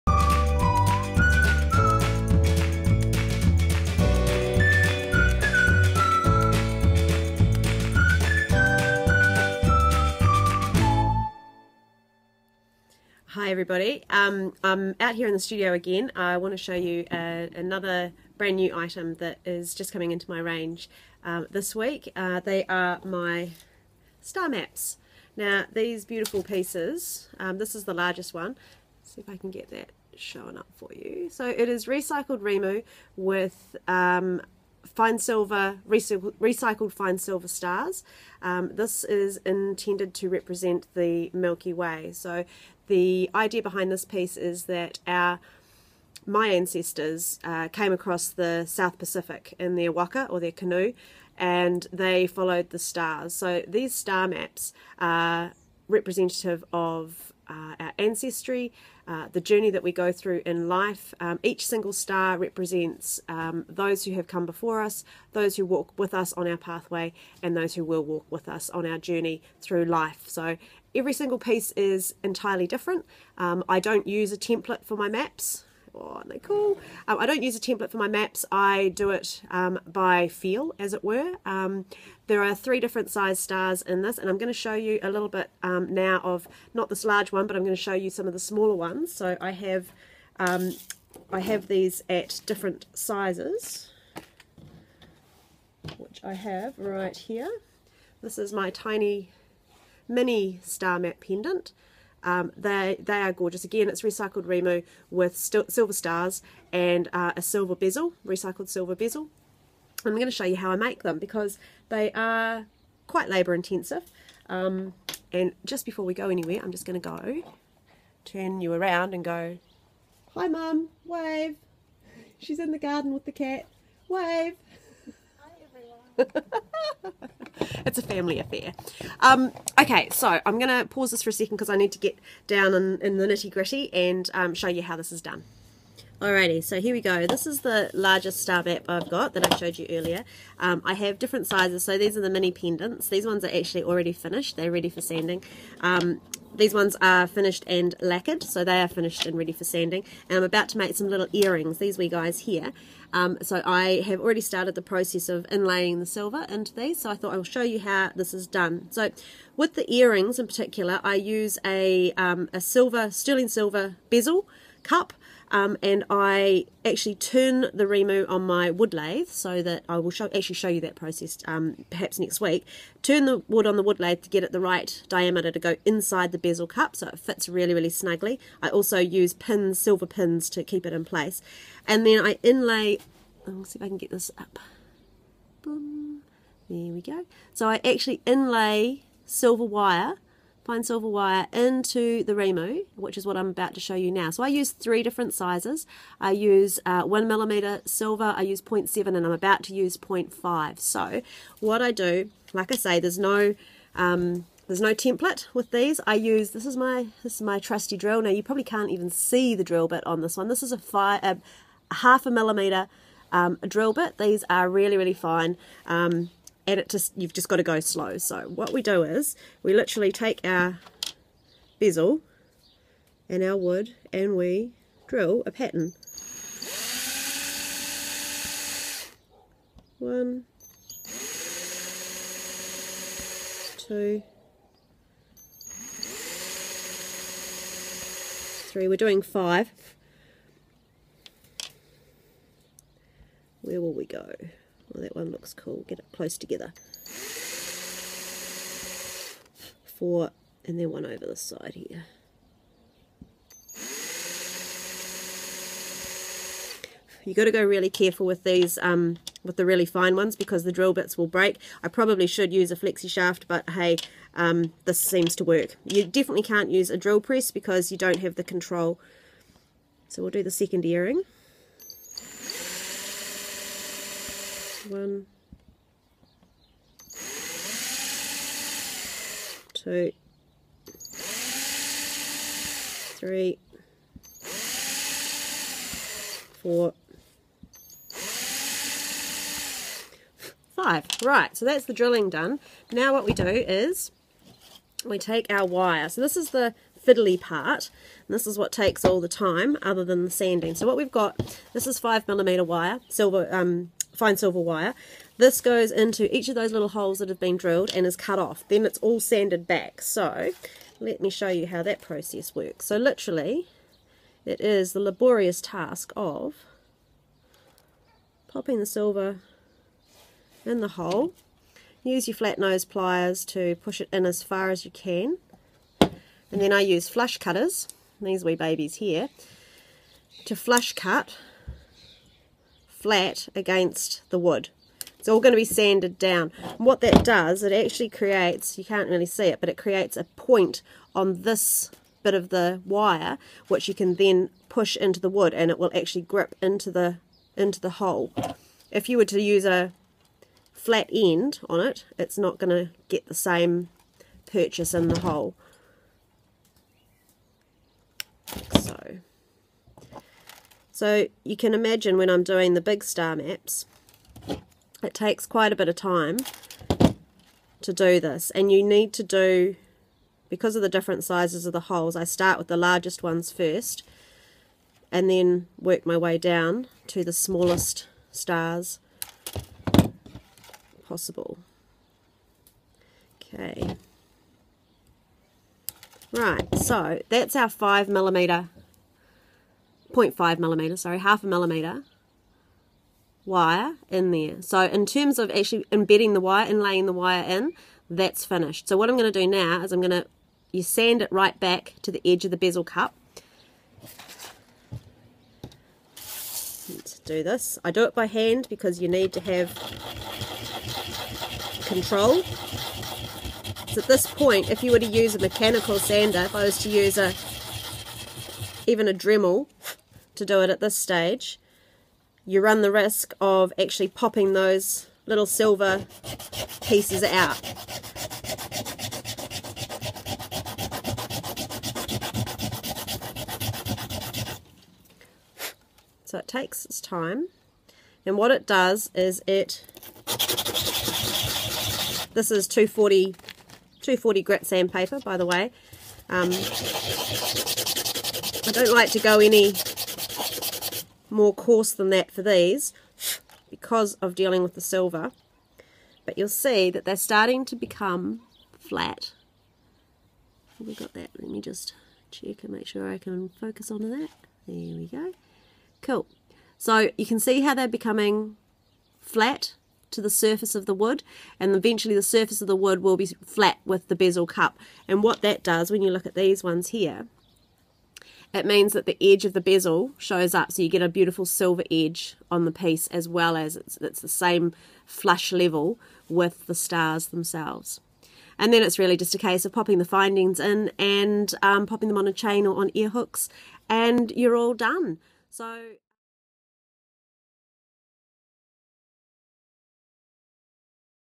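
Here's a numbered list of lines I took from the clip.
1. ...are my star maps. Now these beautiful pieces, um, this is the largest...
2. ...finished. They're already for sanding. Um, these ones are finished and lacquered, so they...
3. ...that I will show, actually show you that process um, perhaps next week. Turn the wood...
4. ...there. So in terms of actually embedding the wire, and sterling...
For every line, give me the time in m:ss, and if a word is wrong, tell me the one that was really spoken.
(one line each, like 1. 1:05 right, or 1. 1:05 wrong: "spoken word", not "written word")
1. 0:22 right
2. 2:24 wrong: "ready", not "already"
3. 2:49 right
4. 6:34 wrong: "laying", not "sterling".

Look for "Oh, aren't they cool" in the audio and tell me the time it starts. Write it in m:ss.
1:15.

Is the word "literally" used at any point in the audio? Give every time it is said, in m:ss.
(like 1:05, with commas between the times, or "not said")
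3:39, 5:12.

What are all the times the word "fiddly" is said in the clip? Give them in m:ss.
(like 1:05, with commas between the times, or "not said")
4:57.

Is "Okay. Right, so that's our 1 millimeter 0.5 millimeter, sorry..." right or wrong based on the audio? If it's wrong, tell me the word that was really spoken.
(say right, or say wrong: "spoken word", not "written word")
wrong: "5", not "1".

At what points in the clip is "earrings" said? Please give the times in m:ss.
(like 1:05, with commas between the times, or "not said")
2:31, 2:39, 4:30.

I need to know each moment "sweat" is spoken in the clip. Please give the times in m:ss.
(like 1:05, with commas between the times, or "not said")
not said.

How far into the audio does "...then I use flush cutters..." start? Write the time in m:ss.
5:26.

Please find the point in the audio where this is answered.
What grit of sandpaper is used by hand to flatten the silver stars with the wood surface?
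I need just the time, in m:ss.
7:24.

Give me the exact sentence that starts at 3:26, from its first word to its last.
I use this is my this is my trusty drill.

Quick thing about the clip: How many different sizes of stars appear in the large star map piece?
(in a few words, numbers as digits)
3.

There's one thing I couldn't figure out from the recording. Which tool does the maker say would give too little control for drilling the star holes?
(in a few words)
Drill press.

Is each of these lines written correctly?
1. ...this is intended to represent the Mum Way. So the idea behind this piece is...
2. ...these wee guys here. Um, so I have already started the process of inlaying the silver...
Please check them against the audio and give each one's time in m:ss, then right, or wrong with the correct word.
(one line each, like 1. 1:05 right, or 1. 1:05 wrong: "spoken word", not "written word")
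1. 0:38 wrong: "Milky", not "Mum"
2. 2:31 right.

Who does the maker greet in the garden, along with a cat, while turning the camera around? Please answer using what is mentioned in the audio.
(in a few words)
Mum.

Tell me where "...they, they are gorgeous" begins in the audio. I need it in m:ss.
1:42.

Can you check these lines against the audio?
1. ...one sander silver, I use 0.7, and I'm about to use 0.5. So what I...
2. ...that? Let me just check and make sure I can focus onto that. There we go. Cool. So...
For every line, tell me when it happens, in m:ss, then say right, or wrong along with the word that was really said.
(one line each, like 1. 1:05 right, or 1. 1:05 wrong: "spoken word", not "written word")
1. 3:17 wrong: "millimeter", not "sander"
2. 7:41 right.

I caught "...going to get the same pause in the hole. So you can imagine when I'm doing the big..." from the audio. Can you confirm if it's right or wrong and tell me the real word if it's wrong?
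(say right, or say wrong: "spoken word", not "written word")
wrong: "purchase", not "pause".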